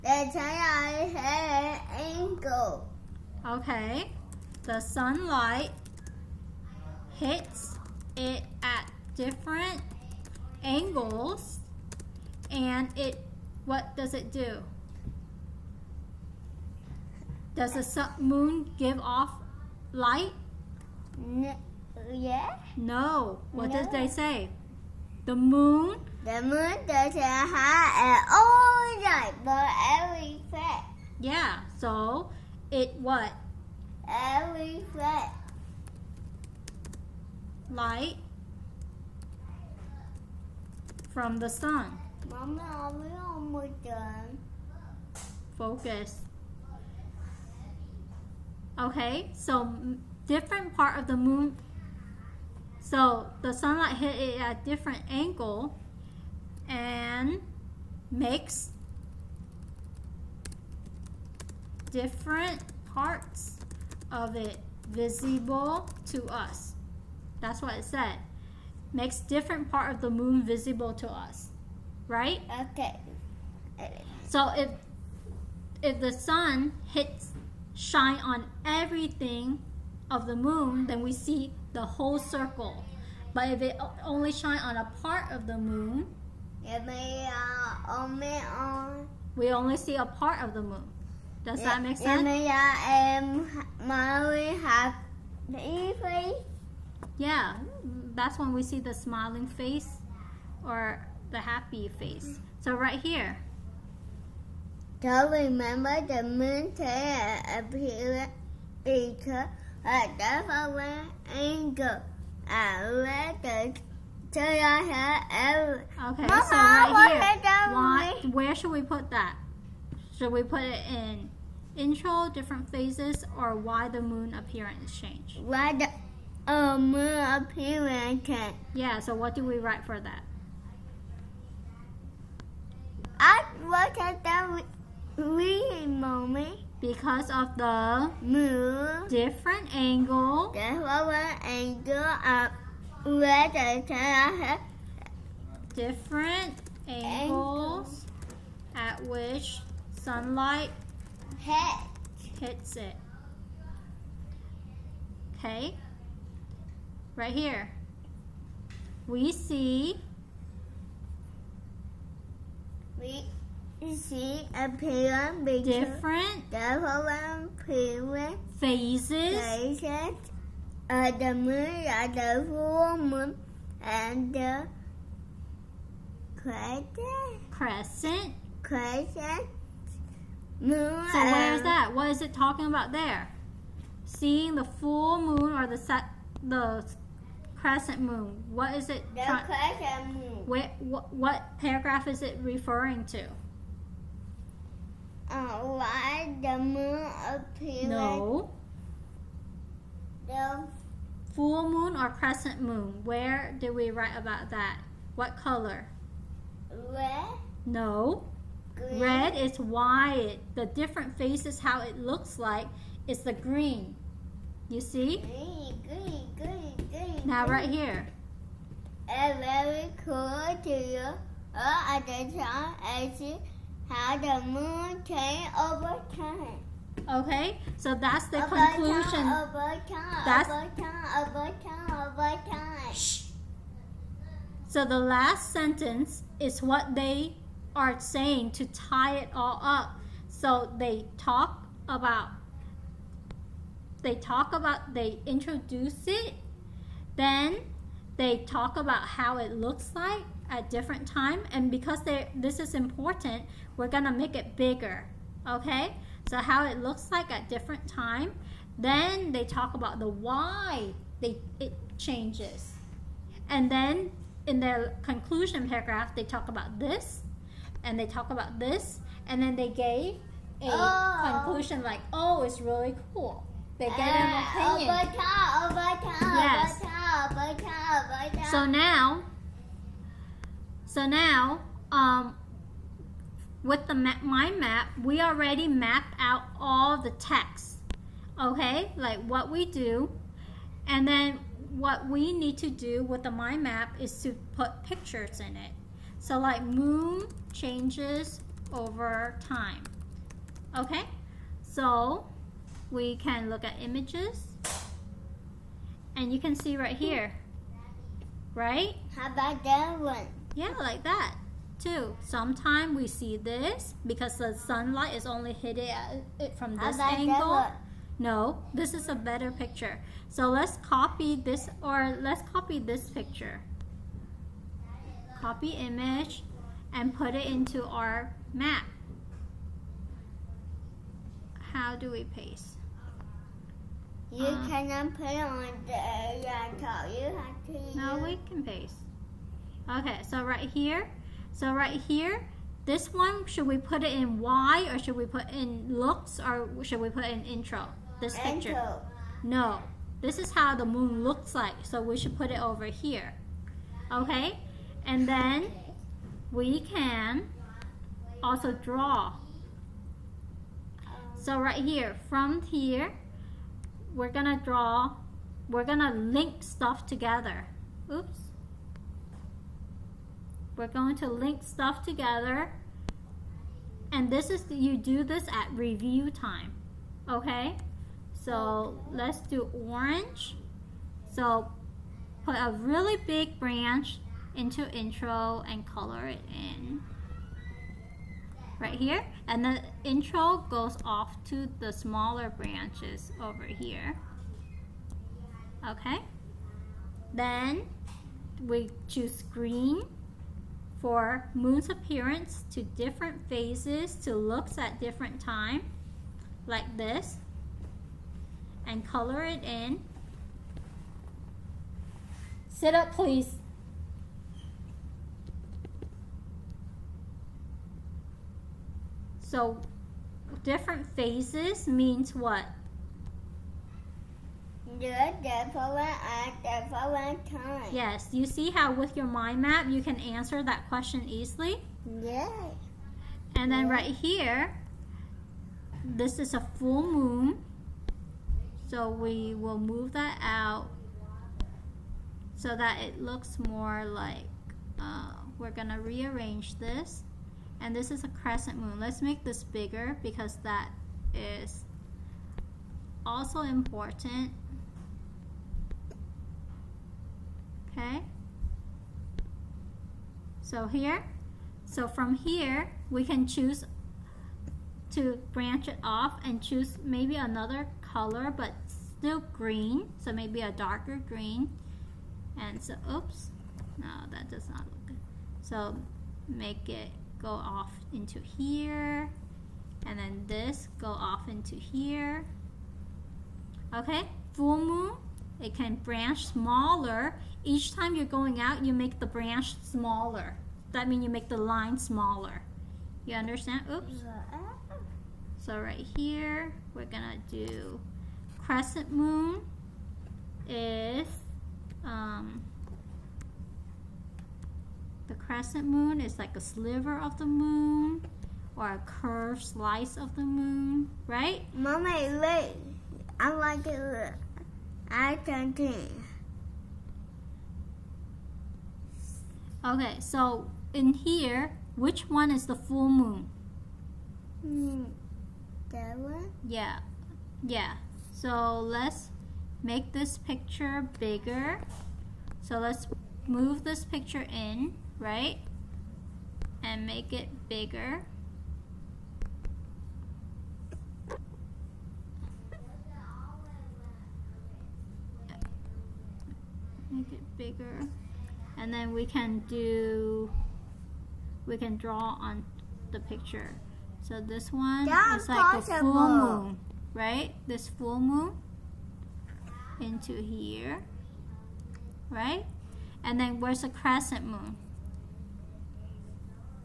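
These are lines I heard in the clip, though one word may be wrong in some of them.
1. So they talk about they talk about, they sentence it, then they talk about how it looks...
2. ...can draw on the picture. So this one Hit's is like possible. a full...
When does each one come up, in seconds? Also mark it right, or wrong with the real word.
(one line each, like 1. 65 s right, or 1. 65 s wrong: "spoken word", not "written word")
1. 240 s wrong: "introduce", not "sentence"
2. 551 s wrong: "That", not "Hit".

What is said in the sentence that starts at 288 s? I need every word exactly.
Okay, like what we do, and then what we need to do with the mind map is to put pictures in it.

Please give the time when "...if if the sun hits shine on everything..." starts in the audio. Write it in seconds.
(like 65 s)
74 s.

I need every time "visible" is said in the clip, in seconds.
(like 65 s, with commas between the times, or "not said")
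64 s, 70 s.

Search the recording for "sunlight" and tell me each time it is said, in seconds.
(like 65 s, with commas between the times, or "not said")
0 s, 4 s, 53 s, 149 s, 314 s.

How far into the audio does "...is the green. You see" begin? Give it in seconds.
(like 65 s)
213 s.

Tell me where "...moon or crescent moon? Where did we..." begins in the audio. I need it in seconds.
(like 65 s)
201 s.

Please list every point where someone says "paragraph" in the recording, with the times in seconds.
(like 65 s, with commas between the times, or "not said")
191 s, 265 s.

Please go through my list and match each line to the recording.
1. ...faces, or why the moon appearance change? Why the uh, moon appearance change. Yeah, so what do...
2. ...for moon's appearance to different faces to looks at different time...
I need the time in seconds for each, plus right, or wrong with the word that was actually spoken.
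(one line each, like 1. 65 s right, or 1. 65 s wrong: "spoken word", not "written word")
1. 122 s wrong: "phases", not "faces"
2. 400 s wrong: "phases", not "faces".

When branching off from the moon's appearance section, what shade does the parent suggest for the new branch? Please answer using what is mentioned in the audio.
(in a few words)
Darker green.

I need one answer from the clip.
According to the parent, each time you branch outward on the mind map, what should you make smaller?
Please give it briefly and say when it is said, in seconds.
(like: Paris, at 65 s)
The line, at 491 s.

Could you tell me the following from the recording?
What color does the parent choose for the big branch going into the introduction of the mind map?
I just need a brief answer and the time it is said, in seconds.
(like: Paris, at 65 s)
Orange, at 379 s.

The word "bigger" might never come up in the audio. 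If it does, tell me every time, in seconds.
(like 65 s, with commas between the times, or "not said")
254 s, 449 s, 531 s, 537 s, 547 s.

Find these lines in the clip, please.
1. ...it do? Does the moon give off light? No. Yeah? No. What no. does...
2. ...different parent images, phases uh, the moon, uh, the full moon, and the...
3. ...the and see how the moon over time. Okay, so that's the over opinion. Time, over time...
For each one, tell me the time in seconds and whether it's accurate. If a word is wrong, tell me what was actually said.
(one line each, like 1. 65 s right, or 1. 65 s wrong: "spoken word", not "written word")
1. 14 s right
2. 166 s wrong: "phases", not "images"
3. 222 s wrong: "conclusion", not "opinion".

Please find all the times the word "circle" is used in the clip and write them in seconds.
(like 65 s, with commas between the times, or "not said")
82 s.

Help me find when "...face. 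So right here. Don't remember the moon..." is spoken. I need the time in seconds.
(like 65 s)
101 s.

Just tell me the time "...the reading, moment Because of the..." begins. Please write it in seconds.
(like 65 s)
134 s.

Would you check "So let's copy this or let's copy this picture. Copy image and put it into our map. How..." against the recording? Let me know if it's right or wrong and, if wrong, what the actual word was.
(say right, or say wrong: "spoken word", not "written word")
right.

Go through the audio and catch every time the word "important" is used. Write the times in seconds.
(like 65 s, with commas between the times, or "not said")
252 s, 453 s.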